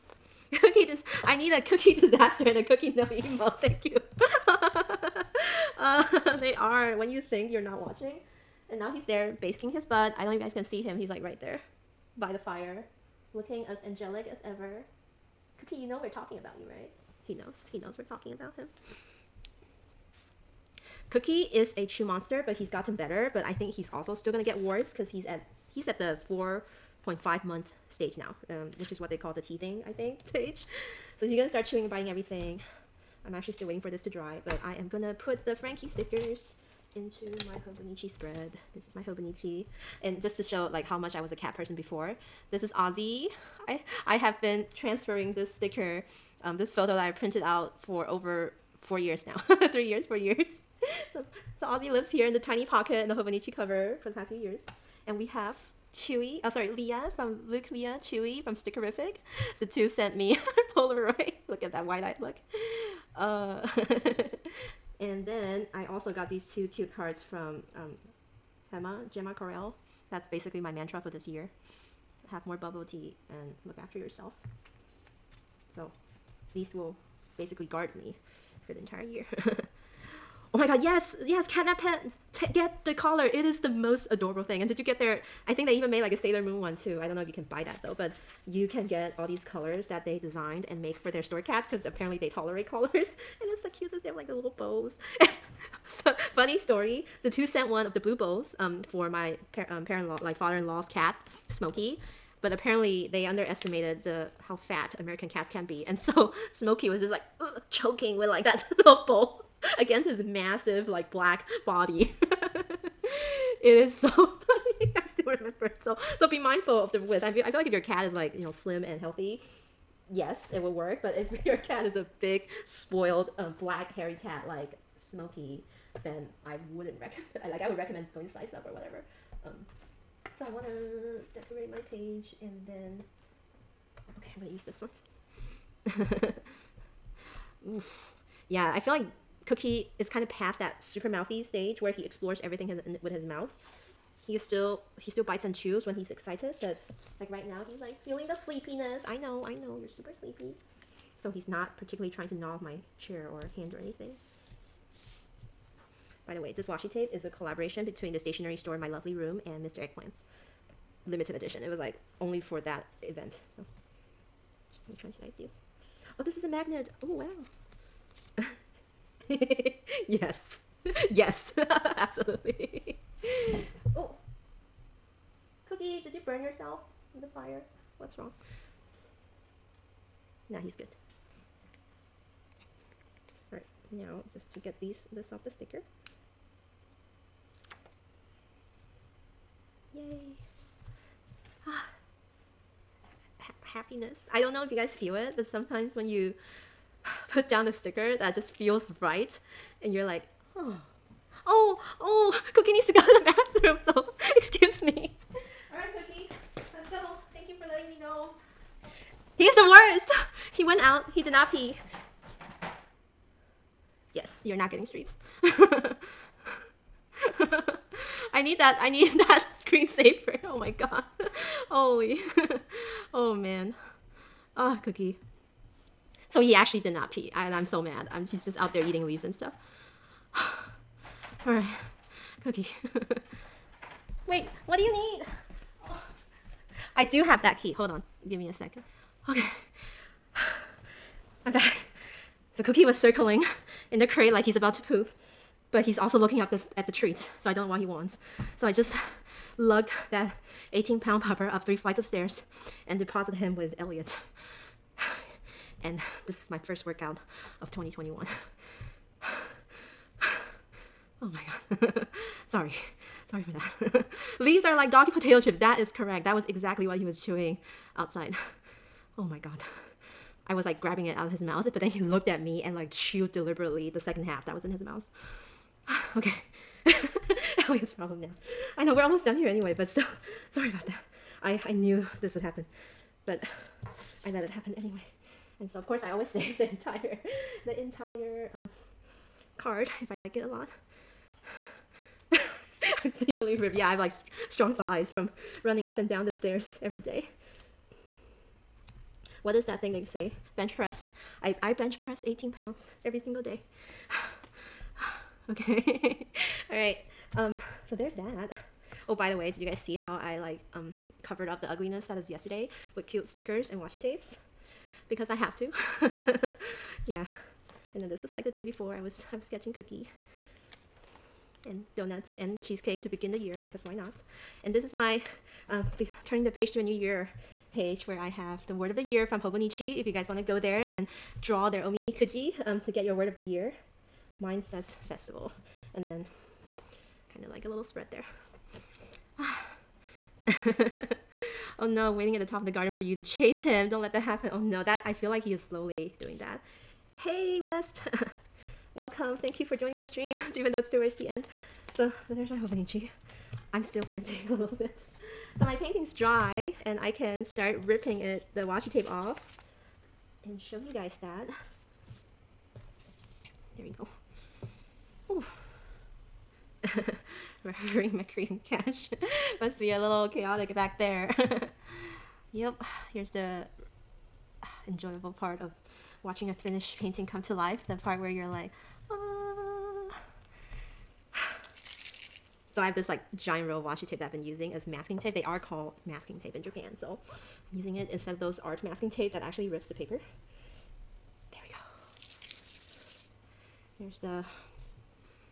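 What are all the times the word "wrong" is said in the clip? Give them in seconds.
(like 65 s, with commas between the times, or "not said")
178 s.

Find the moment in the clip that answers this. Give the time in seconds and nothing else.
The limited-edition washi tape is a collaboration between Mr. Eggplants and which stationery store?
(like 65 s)
158 s.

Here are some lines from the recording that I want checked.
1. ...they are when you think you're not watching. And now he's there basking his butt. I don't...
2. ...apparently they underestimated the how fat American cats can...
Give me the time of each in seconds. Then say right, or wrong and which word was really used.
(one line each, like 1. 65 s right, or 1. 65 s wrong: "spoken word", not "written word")
1. 6 s right
2. 102 s right.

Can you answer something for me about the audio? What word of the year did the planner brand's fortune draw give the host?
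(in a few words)
festival.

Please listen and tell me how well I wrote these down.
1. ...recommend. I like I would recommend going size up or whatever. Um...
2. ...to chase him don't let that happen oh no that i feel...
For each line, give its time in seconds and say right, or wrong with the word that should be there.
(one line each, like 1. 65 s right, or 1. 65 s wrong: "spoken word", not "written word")
1. 127 s right
2. 343 s right.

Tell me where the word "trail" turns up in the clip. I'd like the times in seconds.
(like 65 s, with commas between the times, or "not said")
not said.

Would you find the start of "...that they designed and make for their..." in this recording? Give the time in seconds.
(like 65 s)
89 s.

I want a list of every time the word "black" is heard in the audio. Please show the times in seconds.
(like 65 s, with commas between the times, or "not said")
111 s, 123 s.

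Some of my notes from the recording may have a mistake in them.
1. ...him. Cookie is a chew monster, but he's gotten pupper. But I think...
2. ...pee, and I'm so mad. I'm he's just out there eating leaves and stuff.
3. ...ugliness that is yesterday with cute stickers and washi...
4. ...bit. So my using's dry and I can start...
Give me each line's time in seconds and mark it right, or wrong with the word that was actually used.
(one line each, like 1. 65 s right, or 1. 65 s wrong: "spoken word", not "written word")
1. 18 s wrong: "better", not "pupper"
2. 227 s right
3. 311 s right
4. 354 s wrong: "painting", not "using".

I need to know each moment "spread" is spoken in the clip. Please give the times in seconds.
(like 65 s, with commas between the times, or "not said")
38 s, 337 s.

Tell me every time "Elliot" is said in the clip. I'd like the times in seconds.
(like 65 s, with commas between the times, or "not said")
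253 s, 277 s.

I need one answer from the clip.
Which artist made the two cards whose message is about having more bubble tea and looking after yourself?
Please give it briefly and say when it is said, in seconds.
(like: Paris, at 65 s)
Gemma Correll, at 69 s.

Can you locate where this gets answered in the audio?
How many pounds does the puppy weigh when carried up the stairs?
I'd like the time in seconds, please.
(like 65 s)
250 s.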